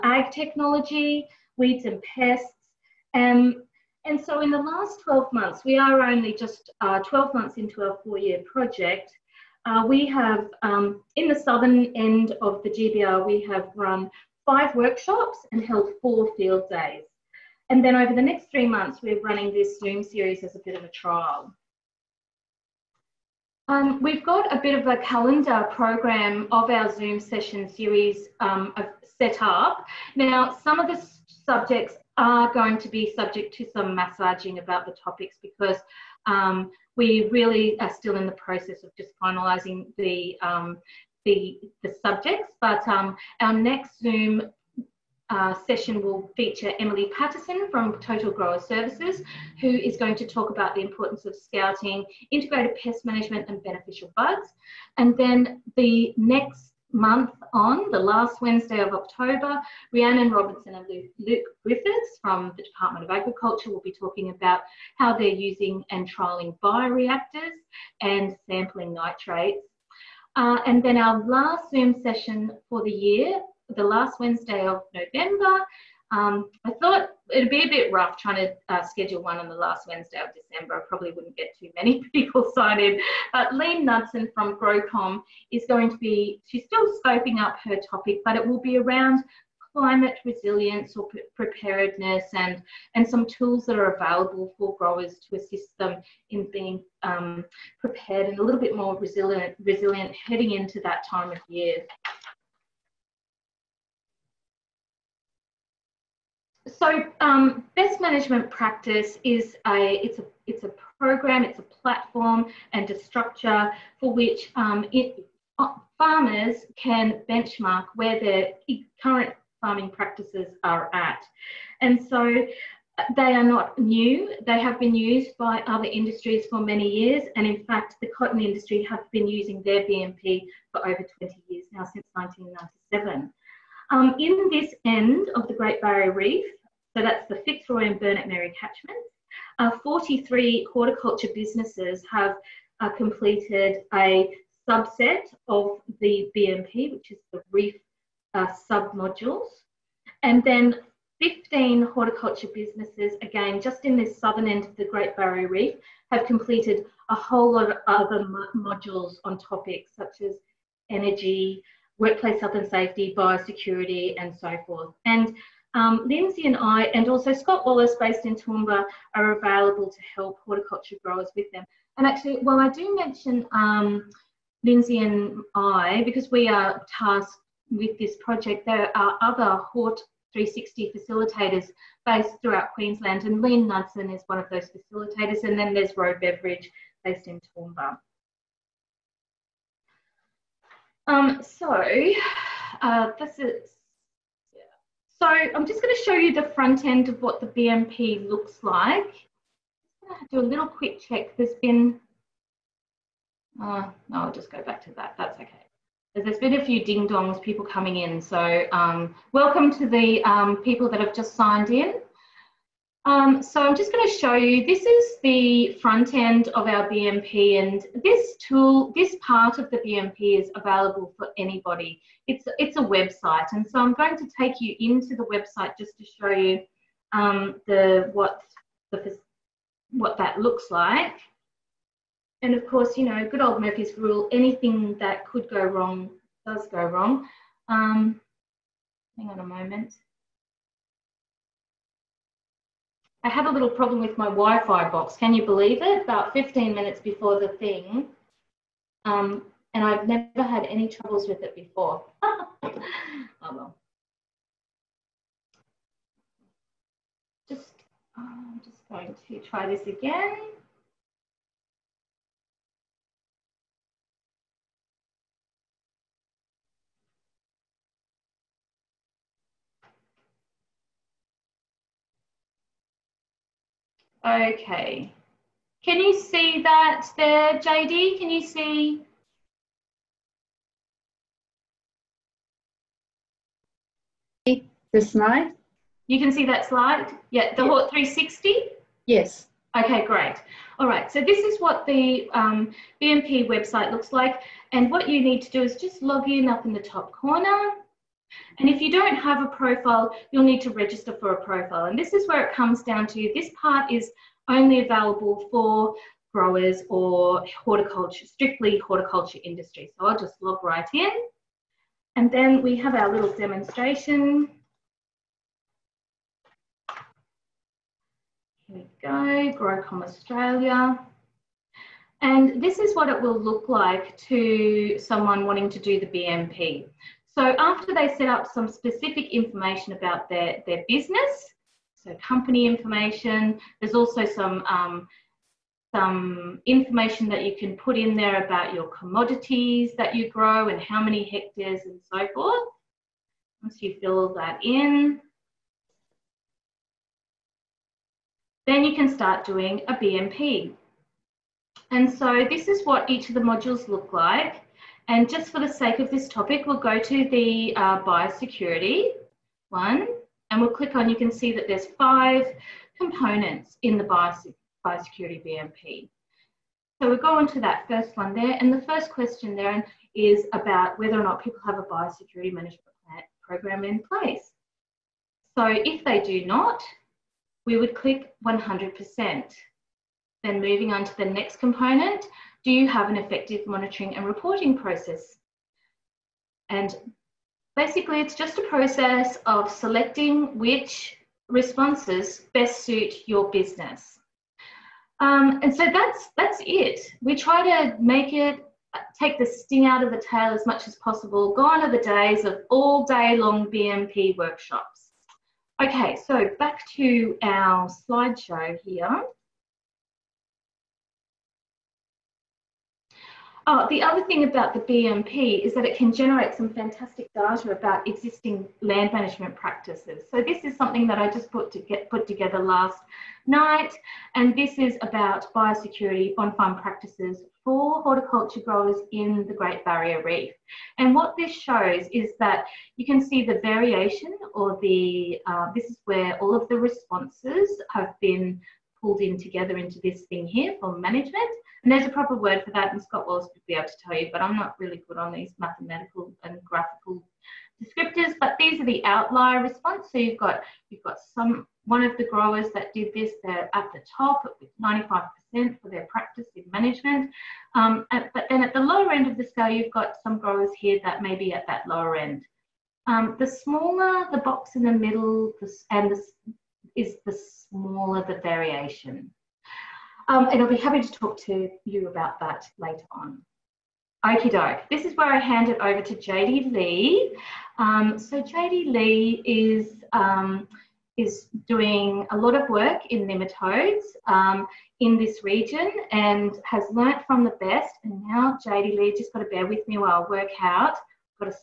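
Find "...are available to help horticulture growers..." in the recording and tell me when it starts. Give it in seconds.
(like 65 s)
169 s.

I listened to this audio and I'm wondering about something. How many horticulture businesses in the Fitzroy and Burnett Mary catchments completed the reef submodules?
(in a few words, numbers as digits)
43.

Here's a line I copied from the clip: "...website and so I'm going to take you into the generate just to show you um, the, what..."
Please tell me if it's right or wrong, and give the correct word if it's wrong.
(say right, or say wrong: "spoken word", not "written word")
wrong: "website", not "generate".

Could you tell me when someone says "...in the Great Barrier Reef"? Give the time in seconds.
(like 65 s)
429 s.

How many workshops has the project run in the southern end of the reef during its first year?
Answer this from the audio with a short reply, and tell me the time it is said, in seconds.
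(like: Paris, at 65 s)
5, at 14 s.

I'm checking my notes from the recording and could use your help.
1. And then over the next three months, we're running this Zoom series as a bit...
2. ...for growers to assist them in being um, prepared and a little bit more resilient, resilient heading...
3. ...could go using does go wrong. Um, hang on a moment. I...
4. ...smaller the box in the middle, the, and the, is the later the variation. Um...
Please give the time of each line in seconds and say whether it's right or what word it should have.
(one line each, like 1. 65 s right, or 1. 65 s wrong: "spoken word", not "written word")
1. 17 s right
2. 94 s right
3. 235 s wrong: "wrong", not "using"
4. 463 s wrong: "smaller", not "later".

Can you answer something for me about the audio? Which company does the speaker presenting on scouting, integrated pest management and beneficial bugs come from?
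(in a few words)
Total Grower Services.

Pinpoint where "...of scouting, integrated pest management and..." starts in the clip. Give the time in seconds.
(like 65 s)
51 s.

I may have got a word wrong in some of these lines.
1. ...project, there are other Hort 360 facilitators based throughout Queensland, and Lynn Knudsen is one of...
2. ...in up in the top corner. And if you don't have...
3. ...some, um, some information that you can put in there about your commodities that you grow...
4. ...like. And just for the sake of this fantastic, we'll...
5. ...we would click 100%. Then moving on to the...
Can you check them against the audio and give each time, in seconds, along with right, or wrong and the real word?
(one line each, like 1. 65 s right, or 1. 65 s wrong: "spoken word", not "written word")
1. 178 s right
2. 296 s right
3. 334 s right
4. 354 s wrong: "topic", not "fantastic"
5. 377 s right.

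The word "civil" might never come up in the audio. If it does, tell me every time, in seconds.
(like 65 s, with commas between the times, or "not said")
not said.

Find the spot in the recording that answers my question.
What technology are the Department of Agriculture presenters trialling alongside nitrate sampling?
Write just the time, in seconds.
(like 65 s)
66 s.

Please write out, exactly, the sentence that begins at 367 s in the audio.
So we'll go on to that first one there.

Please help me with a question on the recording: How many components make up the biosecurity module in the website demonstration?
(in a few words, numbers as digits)
5.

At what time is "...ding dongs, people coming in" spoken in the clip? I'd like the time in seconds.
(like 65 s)
206 s.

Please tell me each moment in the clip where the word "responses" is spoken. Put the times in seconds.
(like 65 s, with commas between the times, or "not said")
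391 s, 436 s, 449 s.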